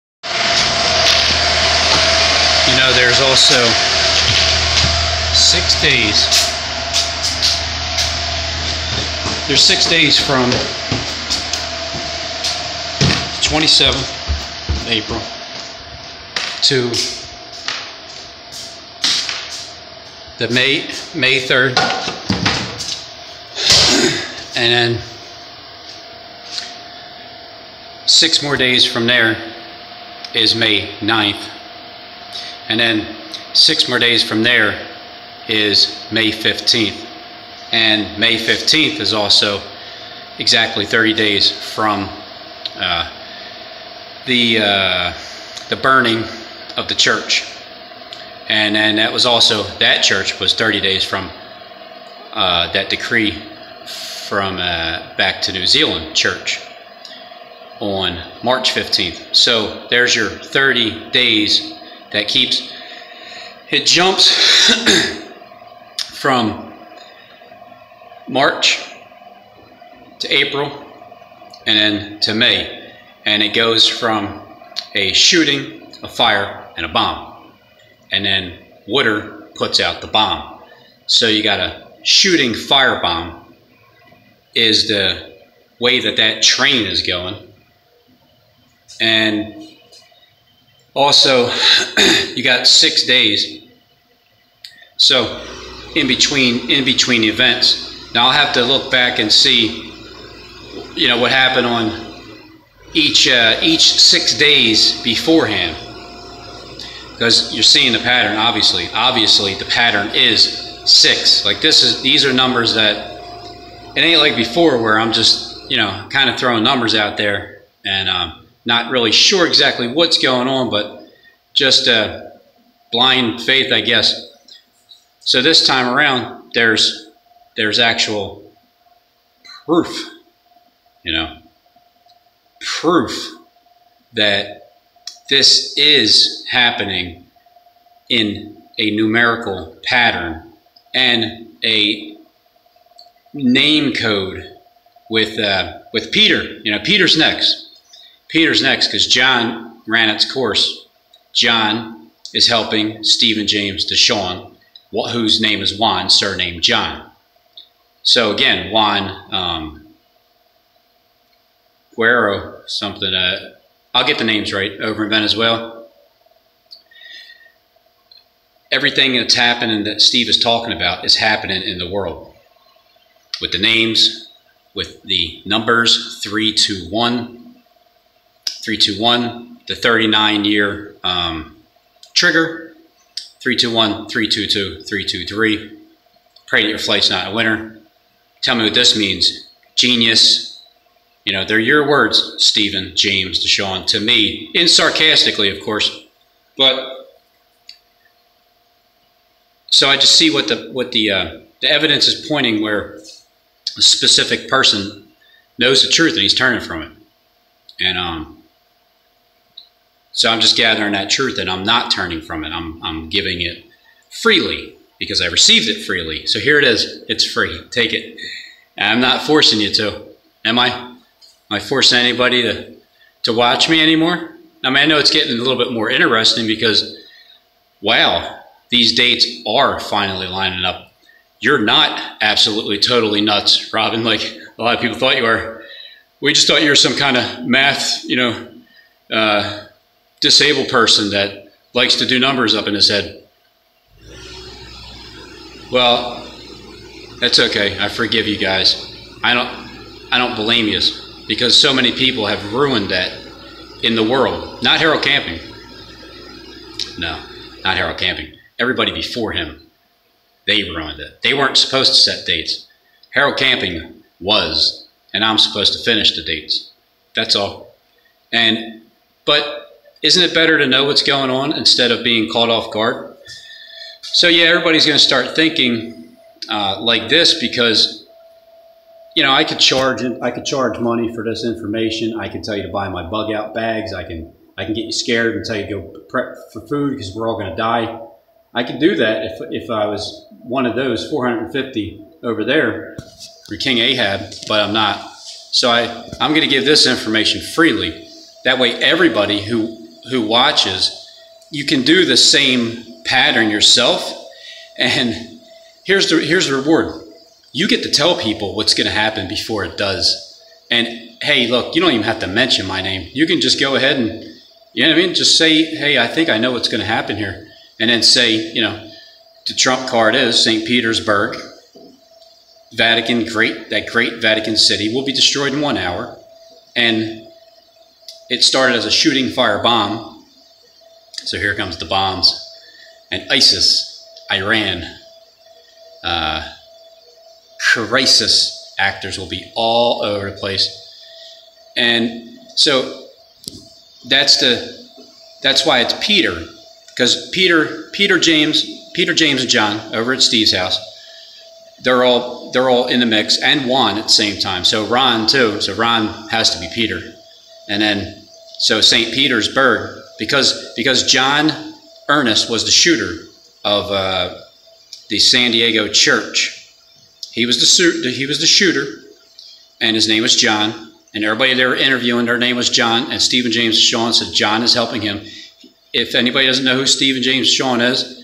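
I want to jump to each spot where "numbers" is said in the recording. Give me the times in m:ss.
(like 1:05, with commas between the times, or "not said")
1:52, 1:56, 2:55, 4:02.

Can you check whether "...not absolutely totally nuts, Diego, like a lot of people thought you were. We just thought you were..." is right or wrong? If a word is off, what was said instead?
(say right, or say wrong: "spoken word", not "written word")
wrong: "Robin", not "Diego".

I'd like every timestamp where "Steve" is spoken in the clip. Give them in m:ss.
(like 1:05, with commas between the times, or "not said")
2:50, 5:50.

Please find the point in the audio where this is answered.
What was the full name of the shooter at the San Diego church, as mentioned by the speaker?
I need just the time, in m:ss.
6:01.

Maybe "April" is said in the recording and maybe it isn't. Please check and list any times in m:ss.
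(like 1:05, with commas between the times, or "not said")
0:14, 1:10.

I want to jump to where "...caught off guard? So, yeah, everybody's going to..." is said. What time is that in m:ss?
4:32.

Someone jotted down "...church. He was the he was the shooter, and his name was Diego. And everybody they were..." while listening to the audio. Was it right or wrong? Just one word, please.
wrong.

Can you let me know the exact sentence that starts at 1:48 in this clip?
Obviously, obviously the pattern is six.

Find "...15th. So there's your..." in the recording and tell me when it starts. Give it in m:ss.
0:58.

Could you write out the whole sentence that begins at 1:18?
And then Wooder puts out the bomb.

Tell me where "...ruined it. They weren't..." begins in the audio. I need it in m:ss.
4:20.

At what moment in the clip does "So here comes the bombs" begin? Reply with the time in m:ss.
5:31.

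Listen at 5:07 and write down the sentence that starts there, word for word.
You get to tell people what's going to happen before it does.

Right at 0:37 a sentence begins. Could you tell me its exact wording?
And May 15th is also exactly 30 days from uh, the, uh, the burning of the church.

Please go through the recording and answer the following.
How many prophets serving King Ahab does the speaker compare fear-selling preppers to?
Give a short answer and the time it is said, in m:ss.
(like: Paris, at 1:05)
450, at 4:51.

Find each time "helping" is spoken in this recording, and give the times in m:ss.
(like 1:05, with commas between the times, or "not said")
2:32, 6:14.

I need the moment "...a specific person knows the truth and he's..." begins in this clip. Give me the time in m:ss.
3:23.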